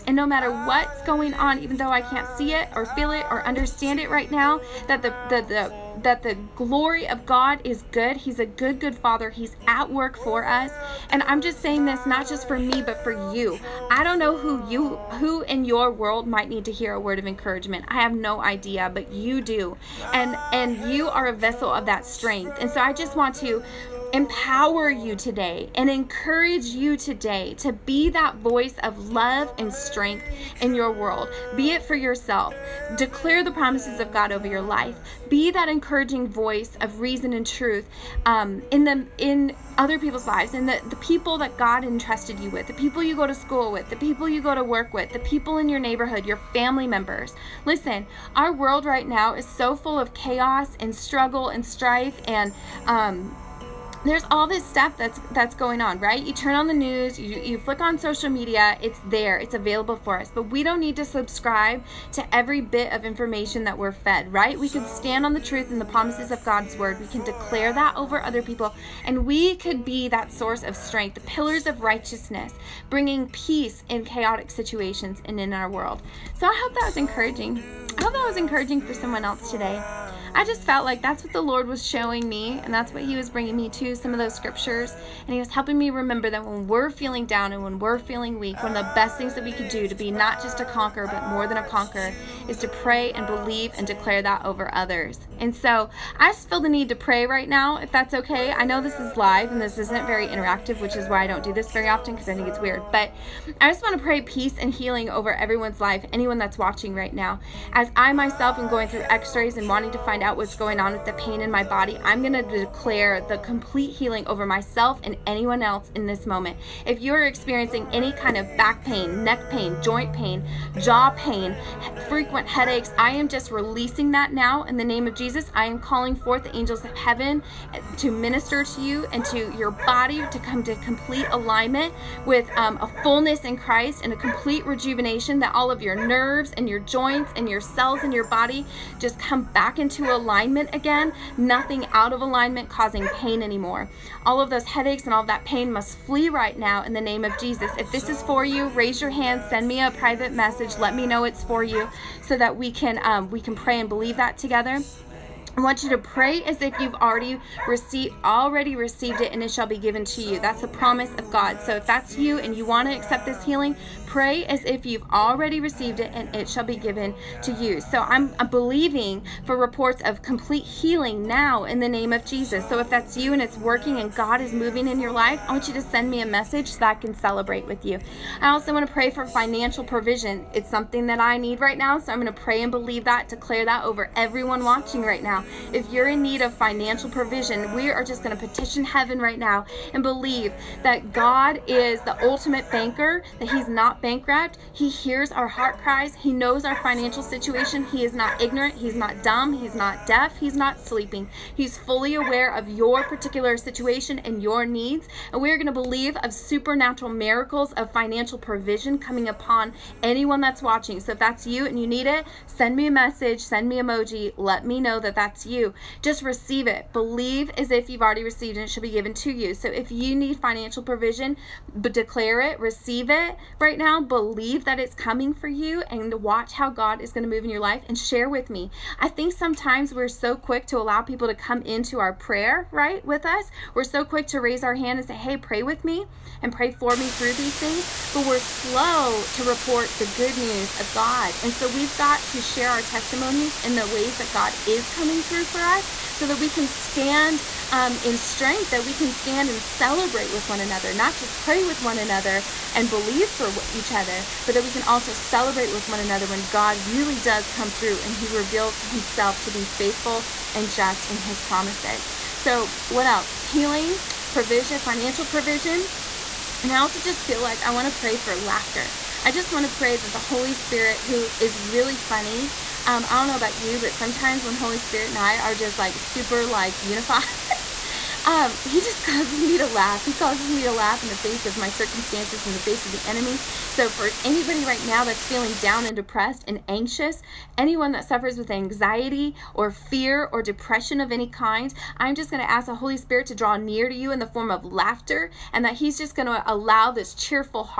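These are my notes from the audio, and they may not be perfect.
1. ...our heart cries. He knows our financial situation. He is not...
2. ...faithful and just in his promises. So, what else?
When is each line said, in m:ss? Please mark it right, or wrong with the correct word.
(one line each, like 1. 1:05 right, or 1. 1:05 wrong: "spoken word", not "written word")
1. 3:15 right
2. 4:19 right.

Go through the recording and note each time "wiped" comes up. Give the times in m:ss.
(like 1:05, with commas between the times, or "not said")
not said.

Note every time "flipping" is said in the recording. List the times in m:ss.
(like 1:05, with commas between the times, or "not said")
not said.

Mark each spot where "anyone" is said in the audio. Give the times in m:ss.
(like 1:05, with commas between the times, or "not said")
1:46, 1:55, 3:30, 4:47.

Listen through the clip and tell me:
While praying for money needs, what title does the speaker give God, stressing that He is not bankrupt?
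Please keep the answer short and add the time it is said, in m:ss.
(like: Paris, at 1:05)
the ultimate banker, at 3:12.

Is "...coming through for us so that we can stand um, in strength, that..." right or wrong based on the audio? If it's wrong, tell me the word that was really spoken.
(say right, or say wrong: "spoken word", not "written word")
right.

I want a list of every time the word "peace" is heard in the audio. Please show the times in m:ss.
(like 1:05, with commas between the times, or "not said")
1:13, 1:44.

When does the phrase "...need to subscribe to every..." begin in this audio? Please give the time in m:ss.
1:00.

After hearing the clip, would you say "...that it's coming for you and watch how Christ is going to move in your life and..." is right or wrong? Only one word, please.
wrong.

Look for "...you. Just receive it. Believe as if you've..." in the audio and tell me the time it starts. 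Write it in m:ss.
3:35.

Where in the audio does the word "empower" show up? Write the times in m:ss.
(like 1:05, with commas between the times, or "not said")
0:24.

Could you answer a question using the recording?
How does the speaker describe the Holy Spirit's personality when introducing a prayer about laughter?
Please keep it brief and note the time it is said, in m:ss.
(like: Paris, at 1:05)
really funny, at 4:31.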